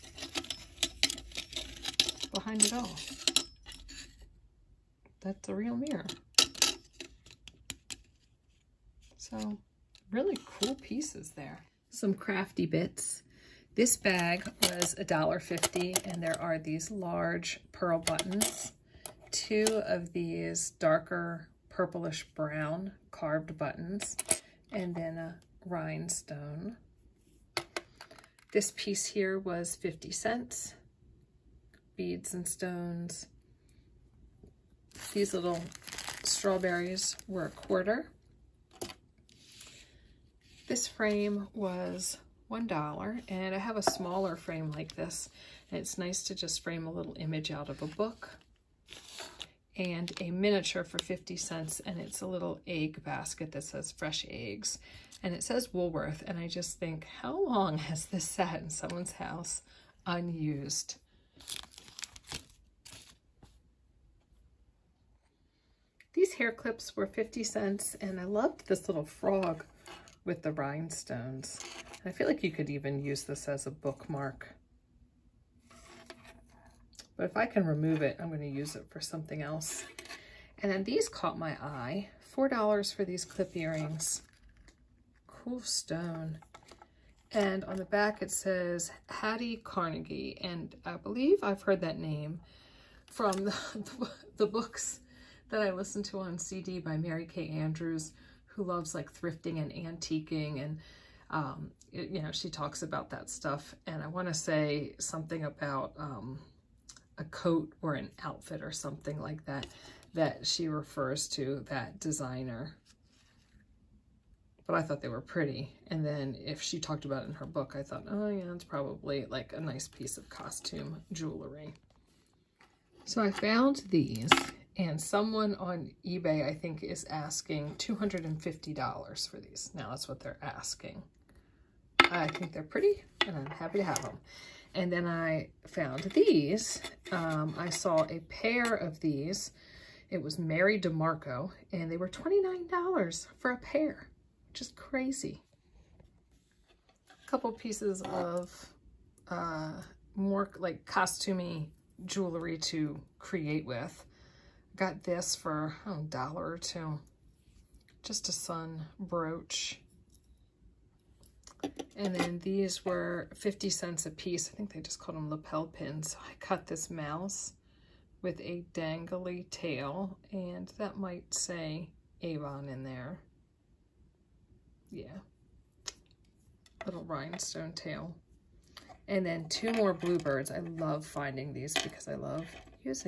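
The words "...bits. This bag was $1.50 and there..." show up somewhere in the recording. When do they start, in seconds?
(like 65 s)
12 s.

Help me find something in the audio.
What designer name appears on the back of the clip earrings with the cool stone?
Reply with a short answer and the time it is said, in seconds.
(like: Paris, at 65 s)
Hattie Carnegie, at 89 s.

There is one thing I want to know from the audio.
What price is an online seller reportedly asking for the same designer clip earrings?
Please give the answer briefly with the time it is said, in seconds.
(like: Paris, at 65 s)
$250, at 127 s.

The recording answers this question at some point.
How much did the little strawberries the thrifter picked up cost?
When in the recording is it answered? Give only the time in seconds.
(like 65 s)
37 s.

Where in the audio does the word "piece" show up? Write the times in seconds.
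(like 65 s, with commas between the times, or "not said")
10 s, 28 s, 119 s, 147 s, 164 s.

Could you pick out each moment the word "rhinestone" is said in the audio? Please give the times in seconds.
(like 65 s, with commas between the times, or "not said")
25 s, 70 s, 177 s.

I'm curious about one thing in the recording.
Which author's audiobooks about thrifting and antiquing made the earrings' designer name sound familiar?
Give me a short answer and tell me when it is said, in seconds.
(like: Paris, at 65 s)
Mary Kay Andrews, at 96 s.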